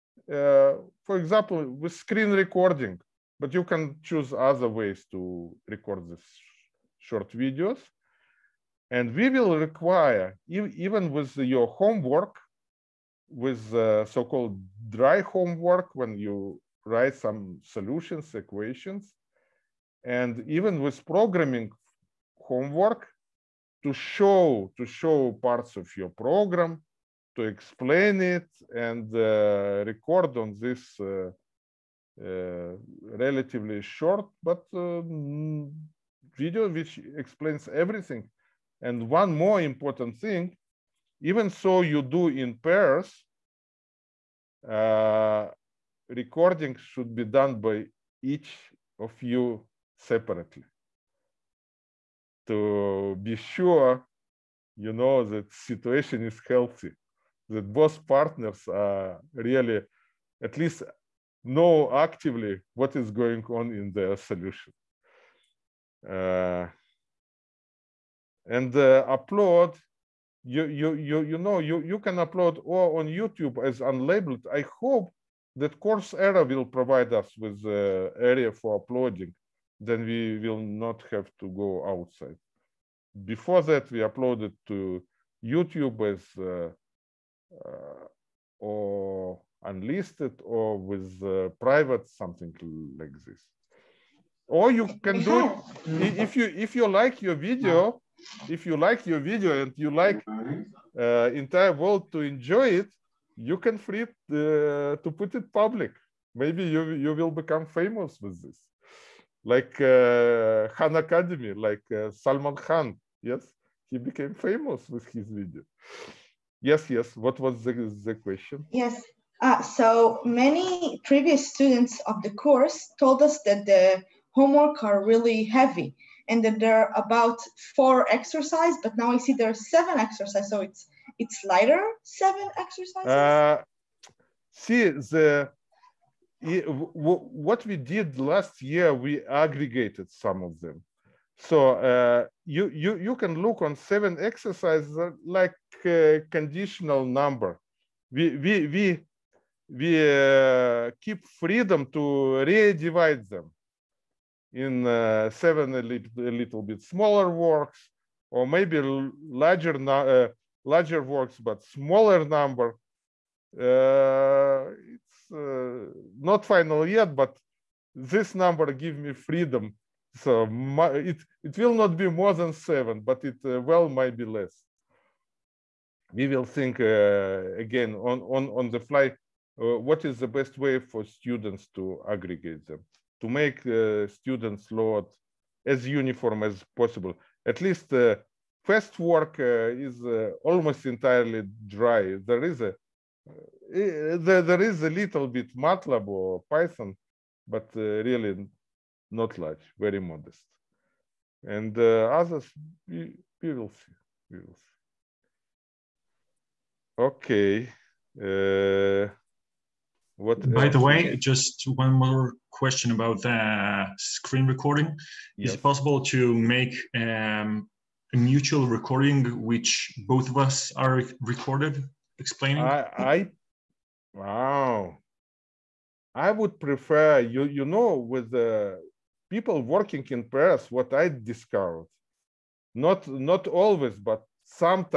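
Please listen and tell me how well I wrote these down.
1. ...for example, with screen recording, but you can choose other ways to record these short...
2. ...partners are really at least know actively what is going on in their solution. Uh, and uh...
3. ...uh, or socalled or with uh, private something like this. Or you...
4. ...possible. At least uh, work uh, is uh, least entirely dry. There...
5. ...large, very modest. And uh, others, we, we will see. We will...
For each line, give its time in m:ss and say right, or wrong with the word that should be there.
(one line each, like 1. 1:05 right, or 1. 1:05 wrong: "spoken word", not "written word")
1. 0:01 right
2. 0:58 right
3. 1:27 wrong: "unlisted", not "socalled"
4. 3:06 wrong: "almost", not "least"
5. 3:19 right.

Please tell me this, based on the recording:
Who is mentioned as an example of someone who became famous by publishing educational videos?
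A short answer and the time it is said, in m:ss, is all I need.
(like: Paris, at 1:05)
Salman Khan, at 1:52.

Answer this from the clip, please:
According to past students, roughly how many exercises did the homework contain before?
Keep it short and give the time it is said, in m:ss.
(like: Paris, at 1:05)
4, at 2:07.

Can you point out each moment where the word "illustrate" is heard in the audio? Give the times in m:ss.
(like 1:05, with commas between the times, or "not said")
not said.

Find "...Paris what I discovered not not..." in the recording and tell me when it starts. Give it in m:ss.
3:50.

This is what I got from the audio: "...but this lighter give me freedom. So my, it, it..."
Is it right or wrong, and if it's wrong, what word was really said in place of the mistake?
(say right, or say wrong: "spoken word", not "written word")
wrong: "number", not "lighter".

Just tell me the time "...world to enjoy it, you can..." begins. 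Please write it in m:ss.
1:41.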